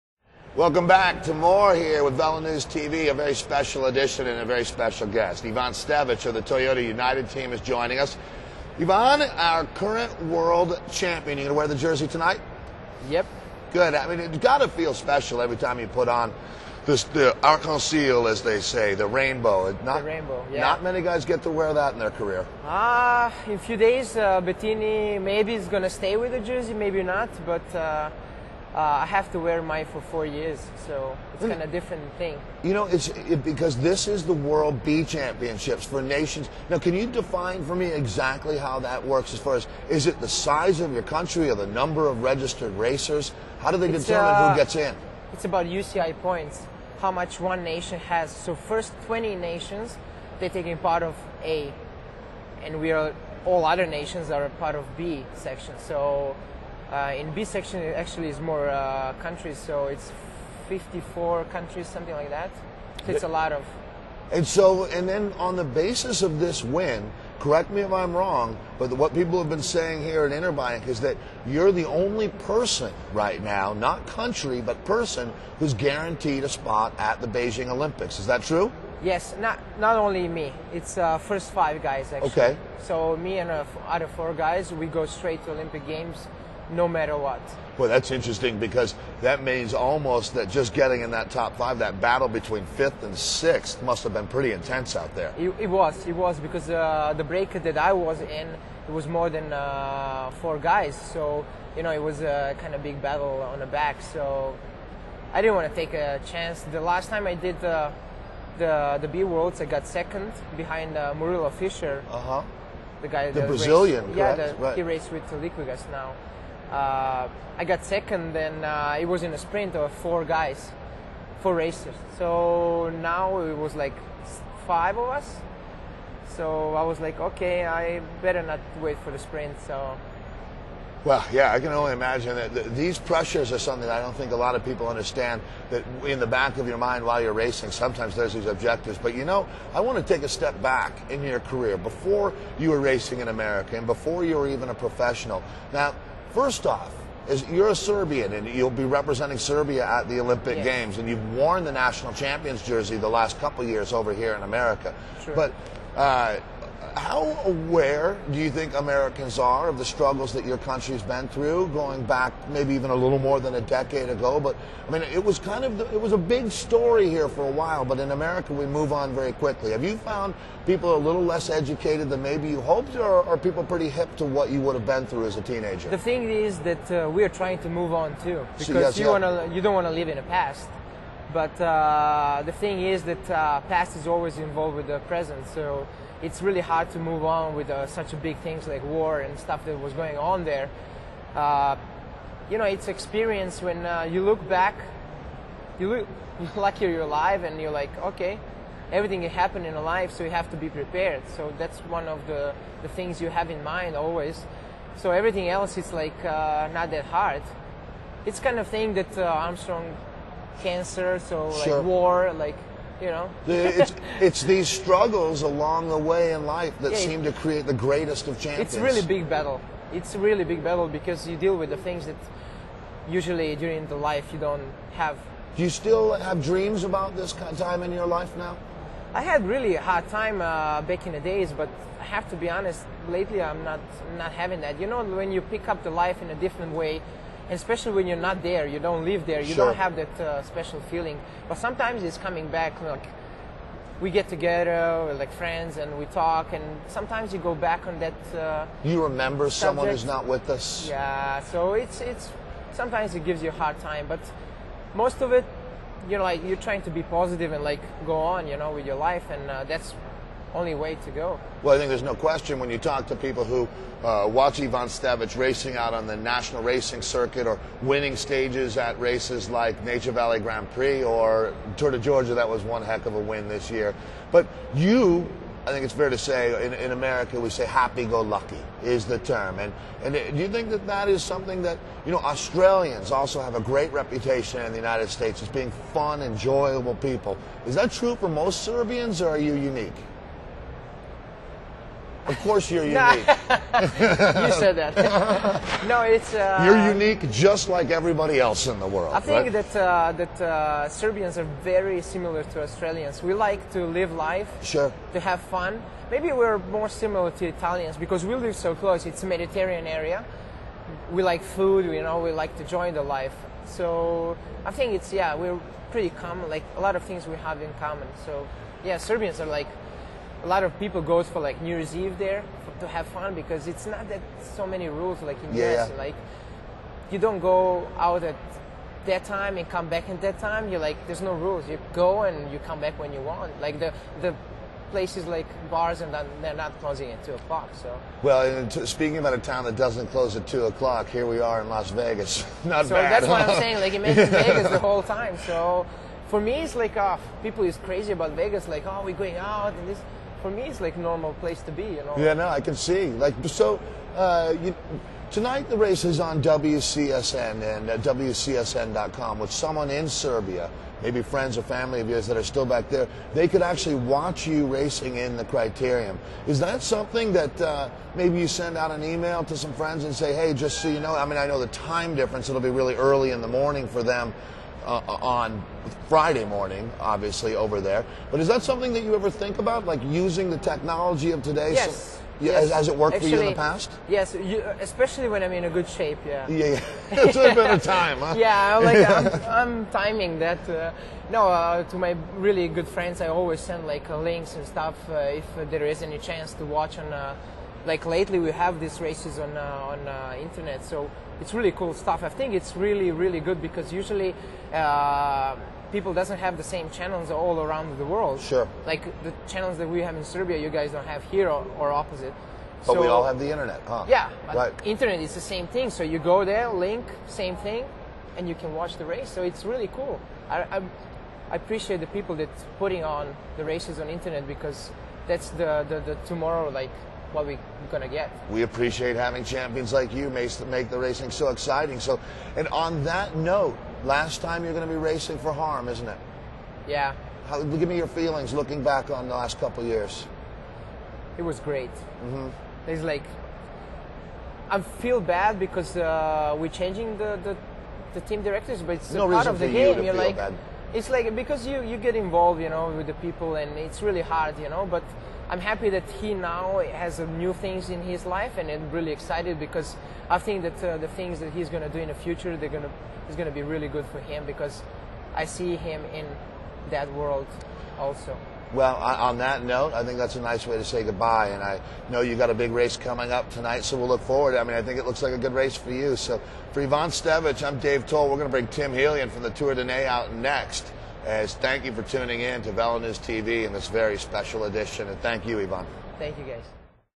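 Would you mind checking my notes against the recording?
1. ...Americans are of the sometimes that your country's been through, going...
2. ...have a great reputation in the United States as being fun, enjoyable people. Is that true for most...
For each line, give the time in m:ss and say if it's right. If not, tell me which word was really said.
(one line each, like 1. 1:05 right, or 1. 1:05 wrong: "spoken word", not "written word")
1. 2:38 wrong: "struggles", not "sometimes"
2. 4:43 right.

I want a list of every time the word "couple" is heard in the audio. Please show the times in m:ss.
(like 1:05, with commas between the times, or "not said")
2:33, 7:19.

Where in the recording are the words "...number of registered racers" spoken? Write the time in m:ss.
0:41.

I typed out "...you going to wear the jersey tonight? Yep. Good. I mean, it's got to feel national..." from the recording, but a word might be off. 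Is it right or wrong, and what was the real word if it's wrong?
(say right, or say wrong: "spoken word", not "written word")
wrong: "special", not "national".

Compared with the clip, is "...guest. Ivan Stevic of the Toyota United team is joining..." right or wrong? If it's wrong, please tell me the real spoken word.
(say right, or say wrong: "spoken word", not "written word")
right.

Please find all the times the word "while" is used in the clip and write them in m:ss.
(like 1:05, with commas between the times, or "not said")
2:17, 2:47.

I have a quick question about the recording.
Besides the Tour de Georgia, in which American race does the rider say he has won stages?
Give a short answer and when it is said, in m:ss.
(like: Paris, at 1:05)
Nature Valley Grand Prix, at 4:29.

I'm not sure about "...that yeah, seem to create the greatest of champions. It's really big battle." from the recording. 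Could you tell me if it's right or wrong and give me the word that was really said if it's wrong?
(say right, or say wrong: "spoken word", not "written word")
right.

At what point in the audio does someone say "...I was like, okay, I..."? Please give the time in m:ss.
2:06.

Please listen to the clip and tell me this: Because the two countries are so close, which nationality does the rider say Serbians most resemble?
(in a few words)
Italians.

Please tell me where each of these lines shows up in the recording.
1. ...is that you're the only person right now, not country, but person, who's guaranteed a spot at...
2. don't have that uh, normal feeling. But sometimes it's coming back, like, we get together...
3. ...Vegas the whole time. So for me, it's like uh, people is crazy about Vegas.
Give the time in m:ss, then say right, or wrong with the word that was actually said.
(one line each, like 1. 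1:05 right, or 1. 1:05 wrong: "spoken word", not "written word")
1. 1:10 right
2. 3:59 wrong: "special", not "normal"
3. 5:44 right.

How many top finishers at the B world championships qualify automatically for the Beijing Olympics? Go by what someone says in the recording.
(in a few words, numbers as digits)
5.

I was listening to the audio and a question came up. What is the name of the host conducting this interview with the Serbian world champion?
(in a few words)
Dave Towle.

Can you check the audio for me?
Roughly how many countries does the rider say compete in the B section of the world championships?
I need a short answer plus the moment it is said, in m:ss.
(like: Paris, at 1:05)
54, at 1:00.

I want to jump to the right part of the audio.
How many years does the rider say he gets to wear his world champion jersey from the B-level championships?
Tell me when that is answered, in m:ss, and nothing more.
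0:29.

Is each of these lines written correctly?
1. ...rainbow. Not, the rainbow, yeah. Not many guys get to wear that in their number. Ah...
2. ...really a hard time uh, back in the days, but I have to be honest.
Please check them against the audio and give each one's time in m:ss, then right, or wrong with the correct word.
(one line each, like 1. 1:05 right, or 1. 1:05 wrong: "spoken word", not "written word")
1. 0:19 wrong: "career", not "number"
2. 3:49 right.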